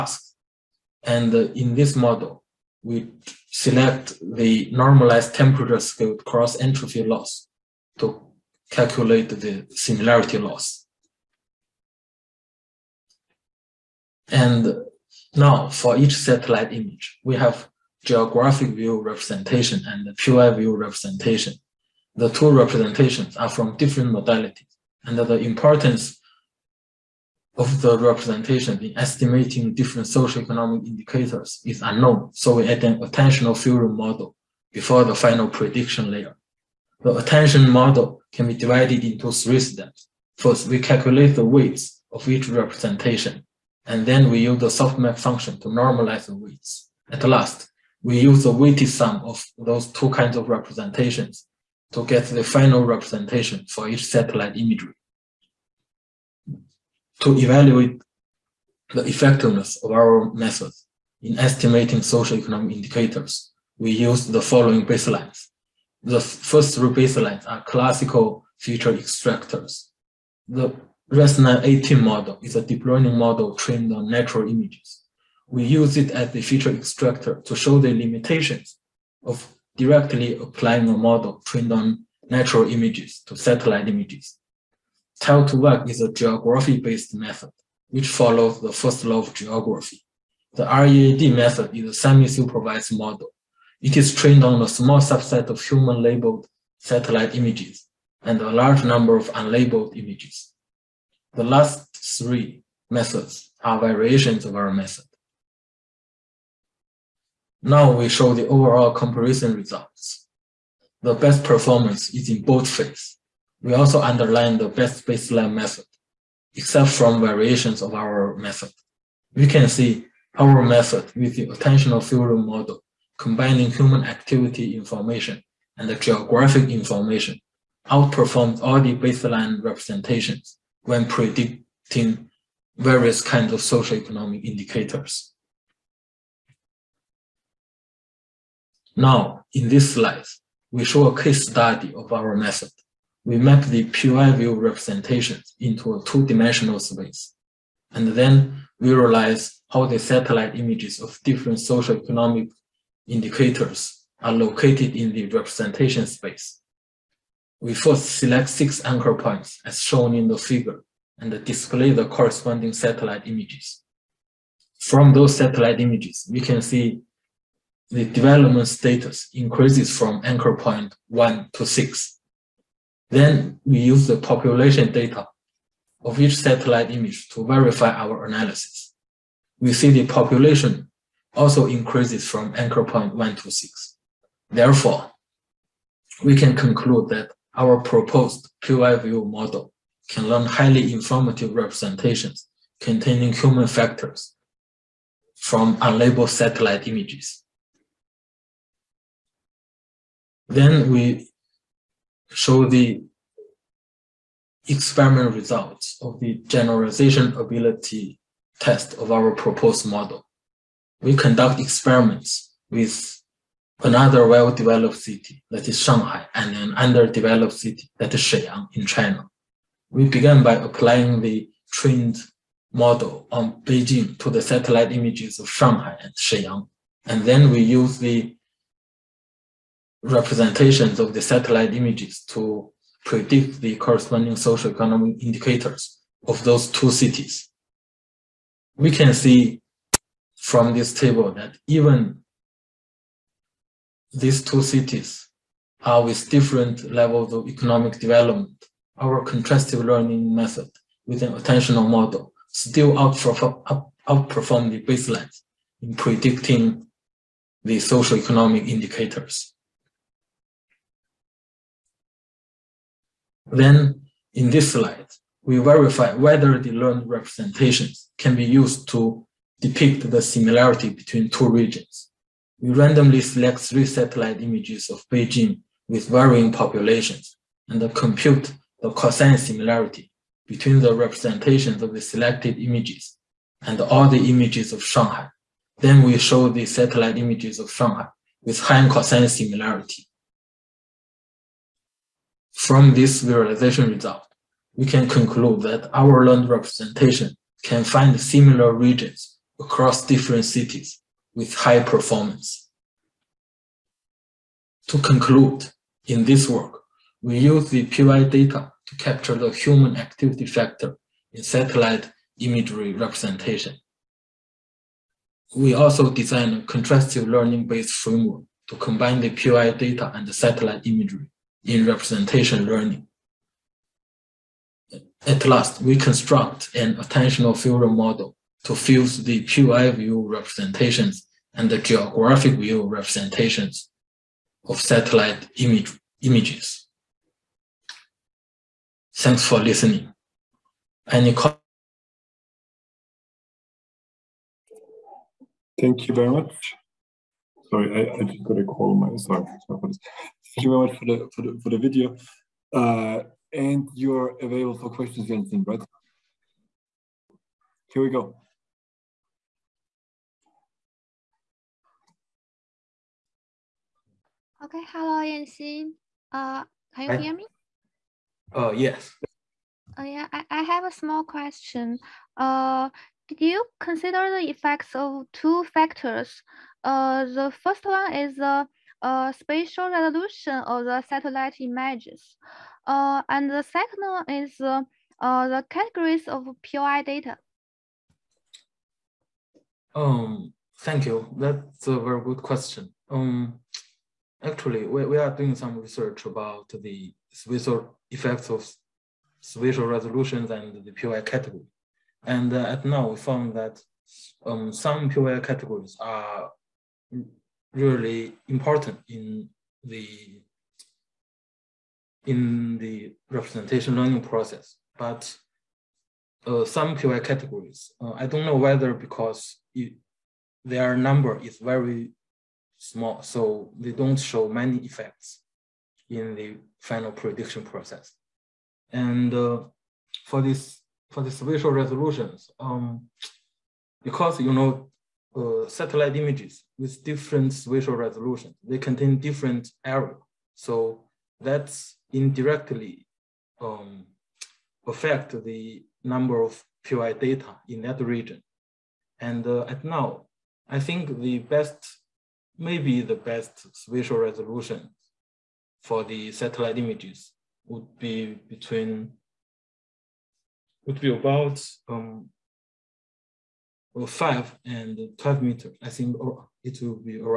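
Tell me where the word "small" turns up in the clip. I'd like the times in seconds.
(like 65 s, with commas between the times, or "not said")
94 s, 370 s, 422 s.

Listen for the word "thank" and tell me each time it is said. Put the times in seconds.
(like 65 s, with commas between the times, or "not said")
339 s, 345 s, 350 s, 390 s.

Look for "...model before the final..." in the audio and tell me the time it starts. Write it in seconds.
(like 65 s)
33 s.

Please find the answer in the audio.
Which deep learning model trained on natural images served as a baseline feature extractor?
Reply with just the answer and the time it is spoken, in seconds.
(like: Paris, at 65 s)
ResNet-18, at 71 s.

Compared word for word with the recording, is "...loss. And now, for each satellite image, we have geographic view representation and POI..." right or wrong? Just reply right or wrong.
right.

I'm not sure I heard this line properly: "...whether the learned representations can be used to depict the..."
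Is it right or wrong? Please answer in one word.
right.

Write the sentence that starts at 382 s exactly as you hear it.
Uh, and the second one is uh, uh, the categories of POI data.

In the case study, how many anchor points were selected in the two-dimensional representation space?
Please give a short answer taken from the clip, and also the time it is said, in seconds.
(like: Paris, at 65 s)
6, at 158 s.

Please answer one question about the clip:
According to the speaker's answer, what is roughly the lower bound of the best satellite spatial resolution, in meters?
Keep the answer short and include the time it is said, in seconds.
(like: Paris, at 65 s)
5, at 464 s.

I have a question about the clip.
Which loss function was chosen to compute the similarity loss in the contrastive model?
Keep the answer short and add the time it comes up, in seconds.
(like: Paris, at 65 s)
Normalized temperature scaled cross entropy loss, at 4 s.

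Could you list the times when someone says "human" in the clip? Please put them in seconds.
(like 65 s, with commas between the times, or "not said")
95 s, 123 s, 193 s, 309 s.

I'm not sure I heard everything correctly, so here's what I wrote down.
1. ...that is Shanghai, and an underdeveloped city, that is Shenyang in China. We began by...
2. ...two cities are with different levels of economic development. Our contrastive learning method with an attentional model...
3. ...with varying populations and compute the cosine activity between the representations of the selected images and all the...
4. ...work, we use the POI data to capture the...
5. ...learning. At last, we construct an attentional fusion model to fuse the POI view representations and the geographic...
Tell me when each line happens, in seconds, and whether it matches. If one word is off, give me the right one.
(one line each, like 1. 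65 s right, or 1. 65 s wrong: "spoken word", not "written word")
1. 215 s right
2. 244 s right
3. 275 s wrong: "similarity", not "activity"
4. 306 s right
5. 322 s right.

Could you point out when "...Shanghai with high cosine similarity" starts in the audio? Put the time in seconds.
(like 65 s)
287 s.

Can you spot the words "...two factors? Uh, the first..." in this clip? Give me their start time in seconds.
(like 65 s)
375 s.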